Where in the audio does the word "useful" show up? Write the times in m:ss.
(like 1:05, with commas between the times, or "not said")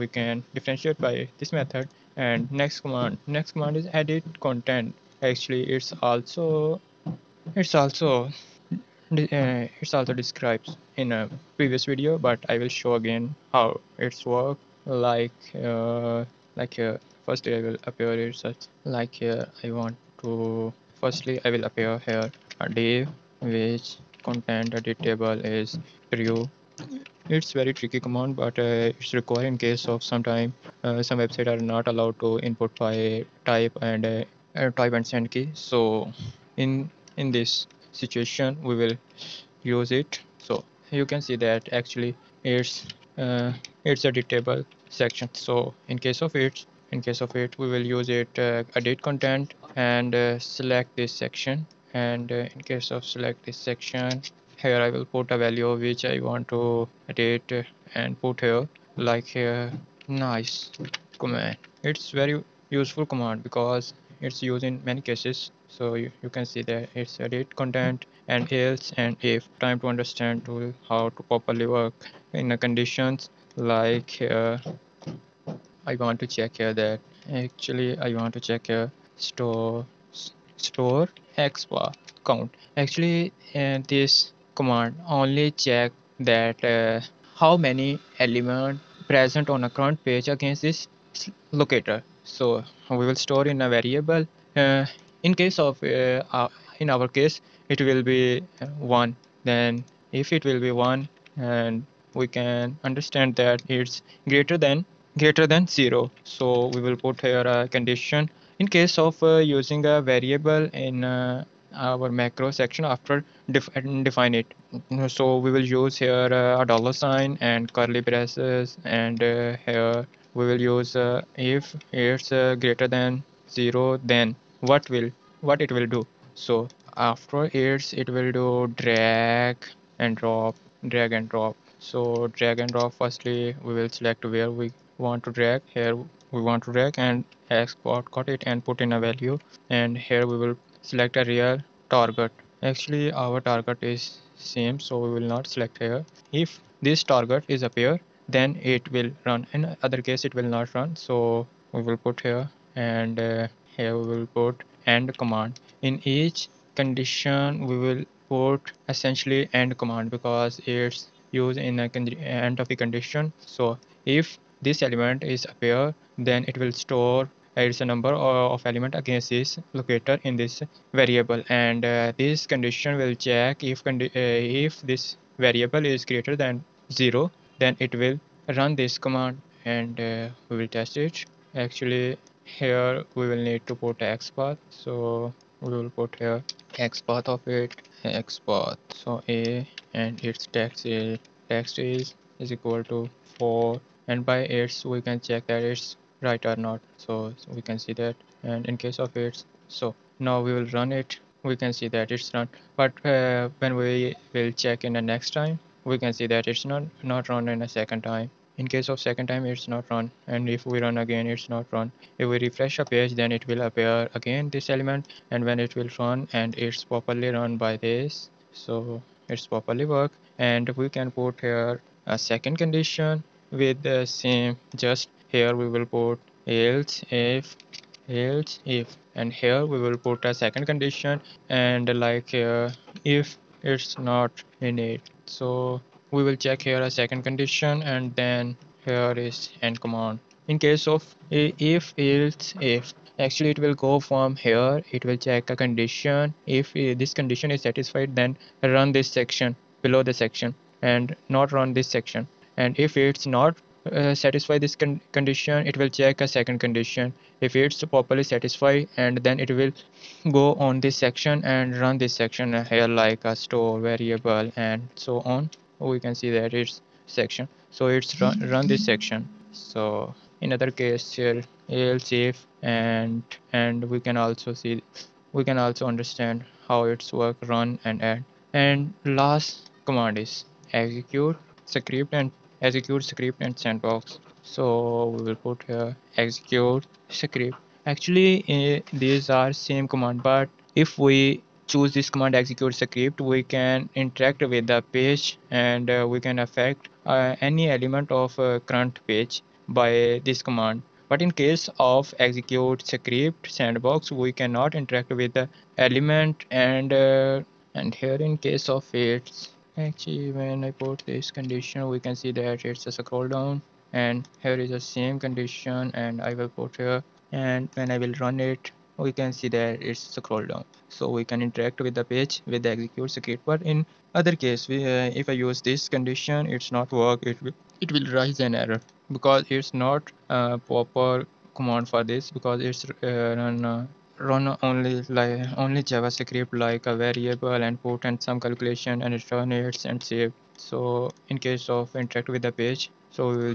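1:02.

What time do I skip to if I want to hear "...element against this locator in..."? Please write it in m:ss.
2:48.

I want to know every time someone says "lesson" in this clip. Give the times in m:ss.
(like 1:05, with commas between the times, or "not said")
not said.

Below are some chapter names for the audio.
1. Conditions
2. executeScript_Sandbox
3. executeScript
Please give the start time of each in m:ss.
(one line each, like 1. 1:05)
1. 1:09
2. 5:25
3. 4:39.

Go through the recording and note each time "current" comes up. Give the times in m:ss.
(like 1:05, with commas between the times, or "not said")
1:29, 4:58.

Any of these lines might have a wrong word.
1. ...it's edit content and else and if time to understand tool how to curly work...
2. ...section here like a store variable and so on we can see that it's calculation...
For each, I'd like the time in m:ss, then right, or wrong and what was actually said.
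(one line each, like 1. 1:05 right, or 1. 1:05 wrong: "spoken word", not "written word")
1. 1:06 wrong: "properly", not "curly"
2. 4:22 wrong: "section", not "calculation".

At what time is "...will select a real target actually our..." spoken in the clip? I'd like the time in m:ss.
2:20.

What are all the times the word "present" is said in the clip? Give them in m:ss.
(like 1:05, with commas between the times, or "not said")
1:29.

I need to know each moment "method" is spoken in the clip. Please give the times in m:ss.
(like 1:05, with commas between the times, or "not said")
0:01.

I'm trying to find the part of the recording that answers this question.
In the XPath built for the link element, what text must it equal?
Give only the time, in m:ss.
3:13.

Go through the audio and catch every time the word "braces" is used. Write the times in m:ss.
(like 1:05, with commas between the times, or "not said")
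1:57.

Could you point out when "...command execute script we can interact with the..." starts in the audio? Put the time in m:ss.
4:52.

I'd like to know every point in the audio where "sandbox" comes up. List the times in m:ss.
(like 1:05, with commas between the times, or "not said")
4:43, 5:03.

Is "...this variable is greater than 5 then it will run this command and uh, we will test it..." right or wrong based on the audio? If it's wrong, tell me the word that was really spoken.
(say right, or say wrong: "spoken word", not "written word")
wrong: "0", not "5".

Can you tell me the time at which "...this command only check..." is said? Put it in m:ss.
1:23.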